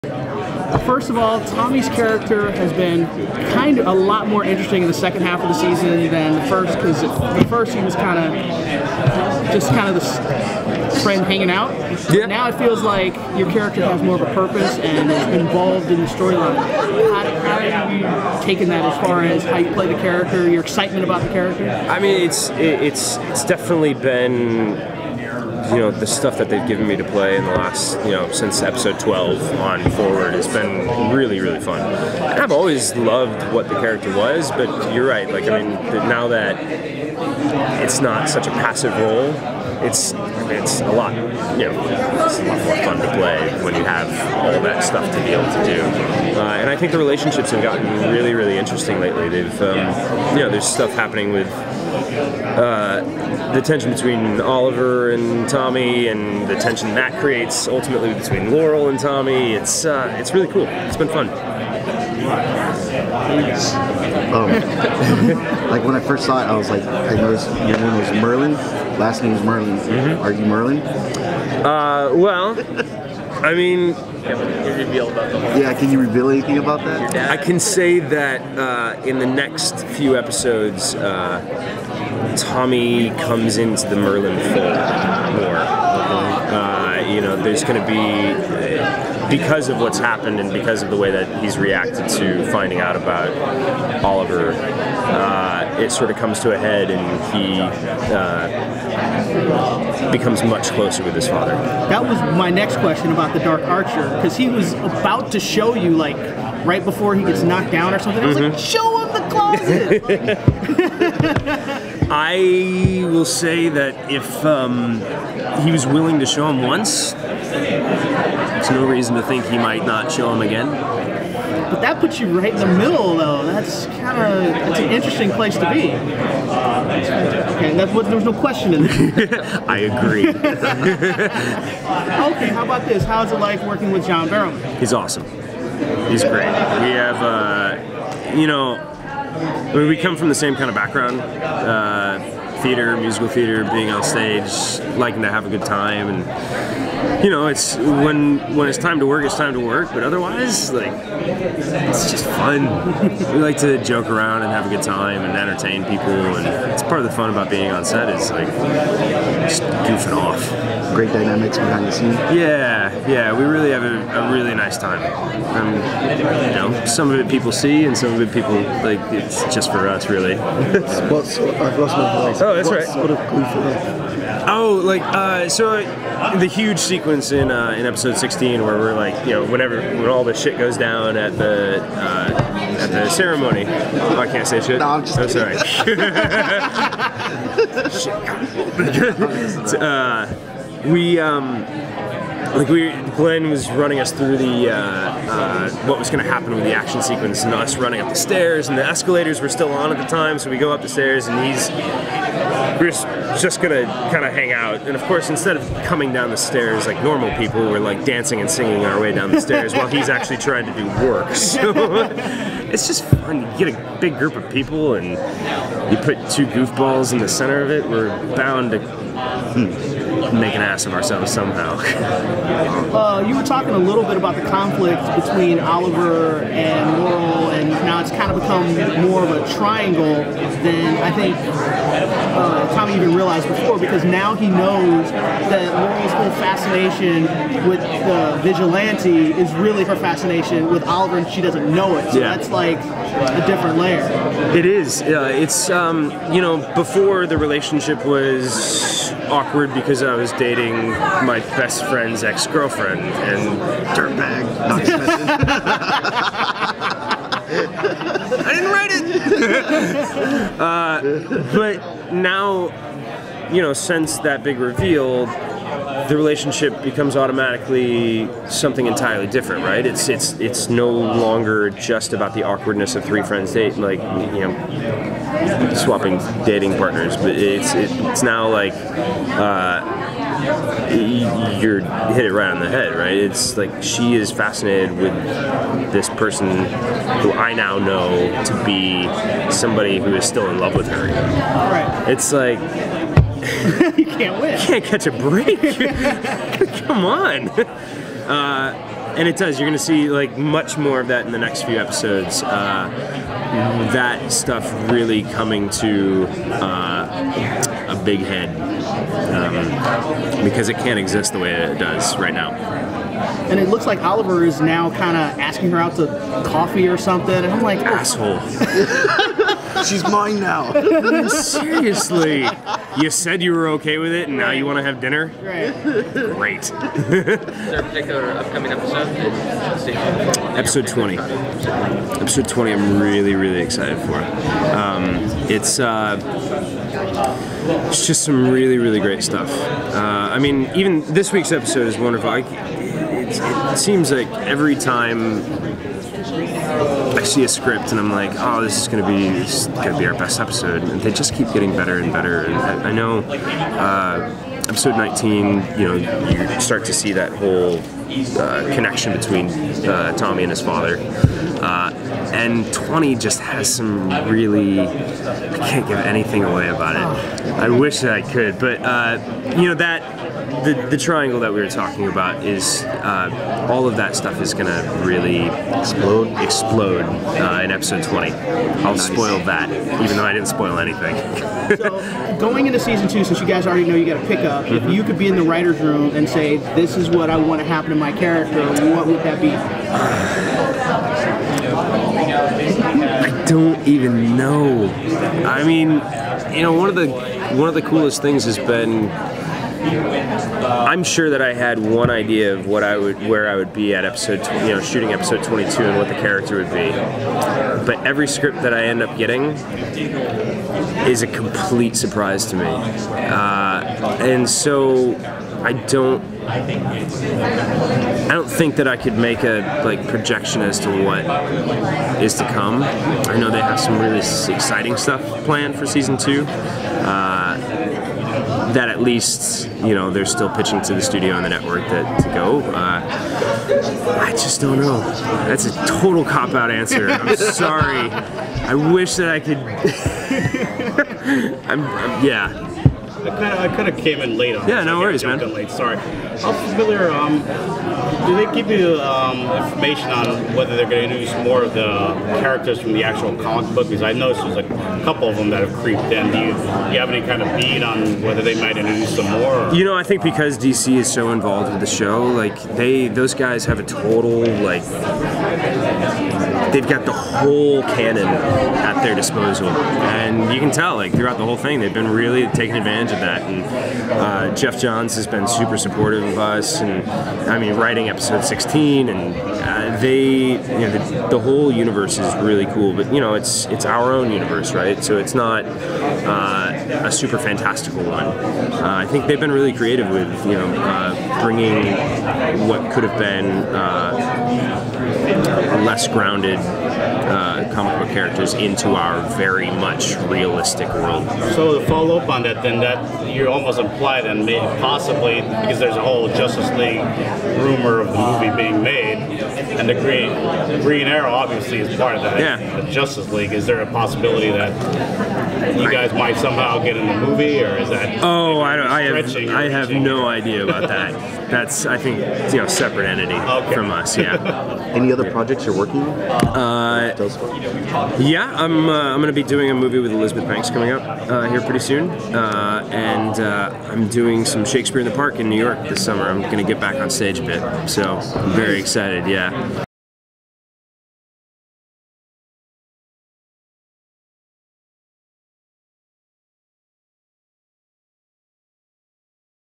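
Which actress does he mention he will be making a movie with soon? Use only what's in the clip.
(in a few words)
Elizabeth Banks.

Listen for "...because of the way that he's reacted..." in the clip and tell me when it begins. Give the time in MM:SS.
01:30.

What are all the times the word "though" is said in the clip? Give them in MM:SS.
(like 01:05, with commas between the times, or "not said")
02:03, 06:20.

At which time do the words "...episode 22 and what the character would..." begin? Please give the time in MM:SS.
06:45.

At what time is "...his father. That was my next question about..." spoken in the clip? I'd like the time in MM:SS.
01:41.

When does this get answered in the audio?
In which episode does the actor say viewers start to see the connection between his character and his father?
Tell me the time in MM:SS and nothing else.
05:54.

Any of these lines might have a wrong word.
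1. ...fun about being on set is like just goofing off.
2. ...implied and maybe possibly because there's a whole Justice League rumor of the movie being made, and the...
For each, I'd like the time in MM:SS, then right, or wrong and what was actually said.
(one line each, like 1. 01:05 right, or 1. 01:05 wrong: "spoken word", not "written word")
1. 02:37 right
2. 08:23 right.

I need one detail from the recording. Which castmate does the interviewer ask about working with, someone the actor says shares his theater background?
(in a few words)
John Barrowman.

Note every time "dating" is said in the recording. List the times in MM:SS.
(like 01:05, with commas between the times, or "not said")
04:10, 04:36.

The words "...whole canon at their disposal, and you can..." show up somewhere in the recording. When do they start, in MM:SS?
07:47.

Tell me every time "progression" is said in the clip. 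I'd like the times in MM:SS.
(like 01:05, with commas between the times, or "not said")
not said.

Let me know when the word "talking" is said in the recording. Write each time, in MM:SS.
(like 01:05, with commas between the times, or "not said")
03:43, 06:11.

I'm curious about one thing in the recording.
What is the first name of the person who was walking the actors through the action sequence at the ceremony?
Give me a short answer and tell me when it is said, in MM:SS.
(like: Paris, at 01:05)
Glenn, at 03:13.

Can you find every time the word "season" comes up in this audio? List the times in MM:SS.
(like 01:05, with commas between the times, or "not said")
00:05, 06:22, 07:05.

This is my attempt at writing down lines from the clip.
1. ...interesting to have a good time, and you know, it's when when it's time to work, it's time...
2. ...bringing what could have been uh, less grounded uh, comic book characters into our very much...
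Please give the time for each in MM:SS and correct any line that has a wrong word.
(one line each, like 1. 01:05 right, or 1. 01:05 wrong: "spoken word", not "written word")
1. 02:24 wrong: "liking", not "interesting"
2. 08:11 right.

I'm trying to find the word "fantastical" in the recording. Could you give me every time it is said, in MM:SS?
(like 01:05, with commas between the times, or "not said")
08:07.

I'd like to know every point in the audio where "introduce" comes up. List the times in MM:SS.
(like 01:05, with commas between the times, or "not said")
07:31, 07:38.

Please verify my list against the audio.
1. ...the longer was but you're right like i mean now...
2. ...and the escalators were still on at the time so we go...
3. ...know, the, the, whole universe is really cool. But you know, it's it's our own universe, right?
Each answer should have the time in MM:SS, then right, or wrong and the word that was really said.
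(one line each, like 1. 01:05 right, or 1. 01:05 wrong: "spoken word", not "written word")
1. 00:33 wrong: "character", not "longer"
2. 03:18 right
3. 08:00 right.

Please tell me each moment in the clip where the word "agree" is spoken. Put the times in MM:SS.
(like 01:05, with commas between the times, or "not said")
02:09.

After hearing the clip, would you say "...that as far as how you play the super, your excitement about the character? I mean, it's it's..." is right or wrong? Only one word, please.
wrong.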